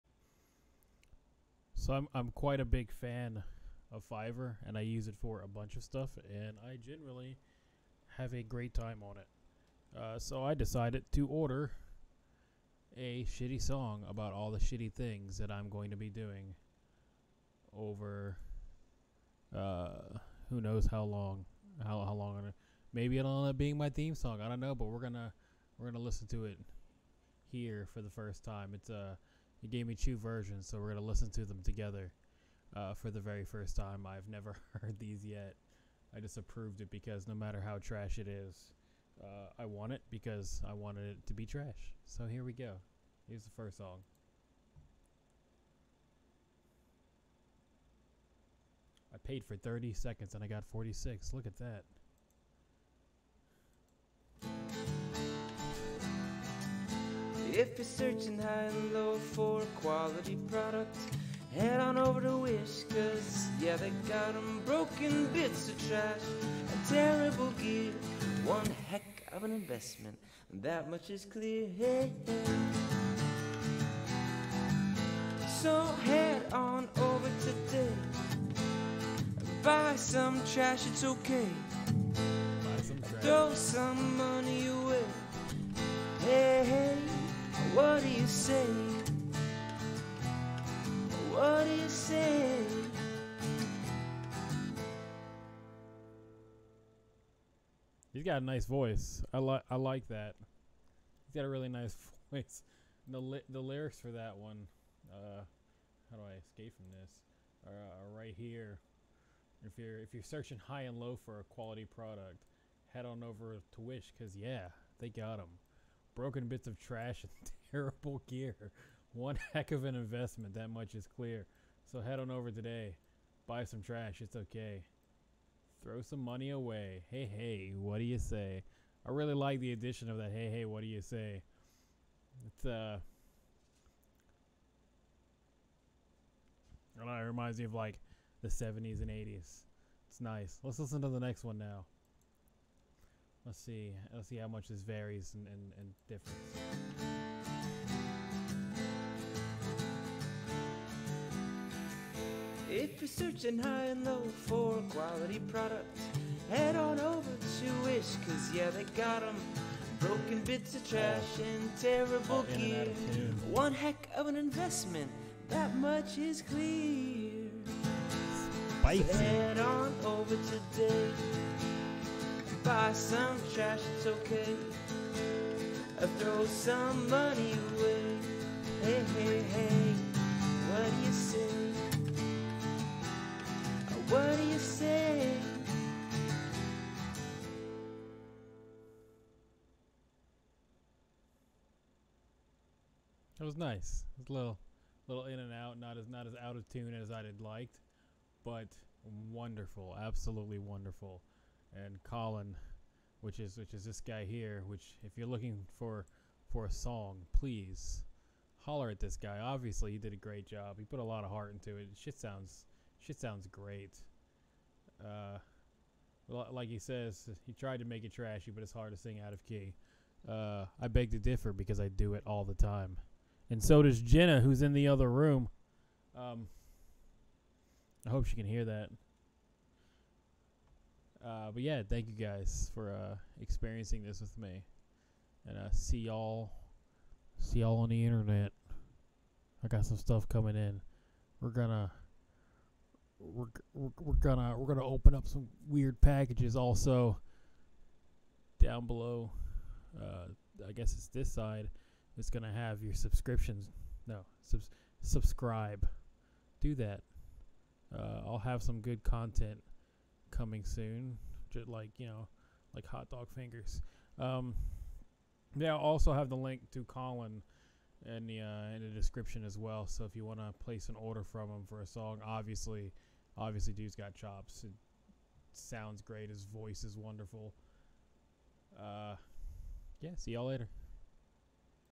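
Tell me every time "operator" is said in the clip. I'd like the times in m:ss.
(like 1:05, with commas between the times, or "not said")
not said.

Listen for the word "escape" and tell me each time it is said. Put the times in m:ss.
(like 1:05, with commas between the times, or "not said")
1:46.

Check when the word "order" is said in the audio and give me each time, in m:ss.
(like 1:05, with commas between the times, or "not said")
0:11, 4:30.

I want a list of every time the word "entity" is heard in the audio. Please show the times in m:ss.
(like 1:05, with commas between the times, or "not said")
not said.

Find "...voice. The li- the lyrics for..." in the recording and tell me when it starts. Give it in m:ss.
1:42.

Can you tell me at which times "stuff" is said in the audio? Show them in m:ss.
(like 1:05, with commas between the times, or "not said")
0:05, 3:59.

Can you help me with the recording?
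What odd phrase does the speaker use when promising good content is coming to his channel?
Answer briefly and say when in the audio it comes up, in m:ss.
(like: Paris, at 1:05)
hot dog fingers, at 4:22.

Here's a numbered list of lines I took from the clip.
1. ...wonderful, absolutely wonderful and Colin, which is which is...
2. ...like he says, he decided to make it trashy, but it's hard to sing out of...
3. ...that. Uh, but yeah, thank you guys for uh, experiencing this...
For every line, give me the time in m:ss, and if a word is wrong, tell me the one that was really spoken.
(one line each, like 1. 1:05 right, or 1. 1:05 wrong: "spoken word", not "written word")
1. 3:19 right
2. 3:36 wrong: "tried", not "decided"
3. 3:48 right.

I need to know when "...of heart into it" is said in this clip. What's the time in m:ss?
3:31.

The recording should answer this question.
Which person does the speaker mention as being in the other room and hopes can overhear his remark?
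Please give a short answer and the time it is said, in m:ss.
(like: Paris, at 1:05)
Jenna, at 3:44.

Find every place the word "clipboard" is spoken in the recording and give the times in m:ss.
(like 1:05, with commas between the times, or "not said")
not said.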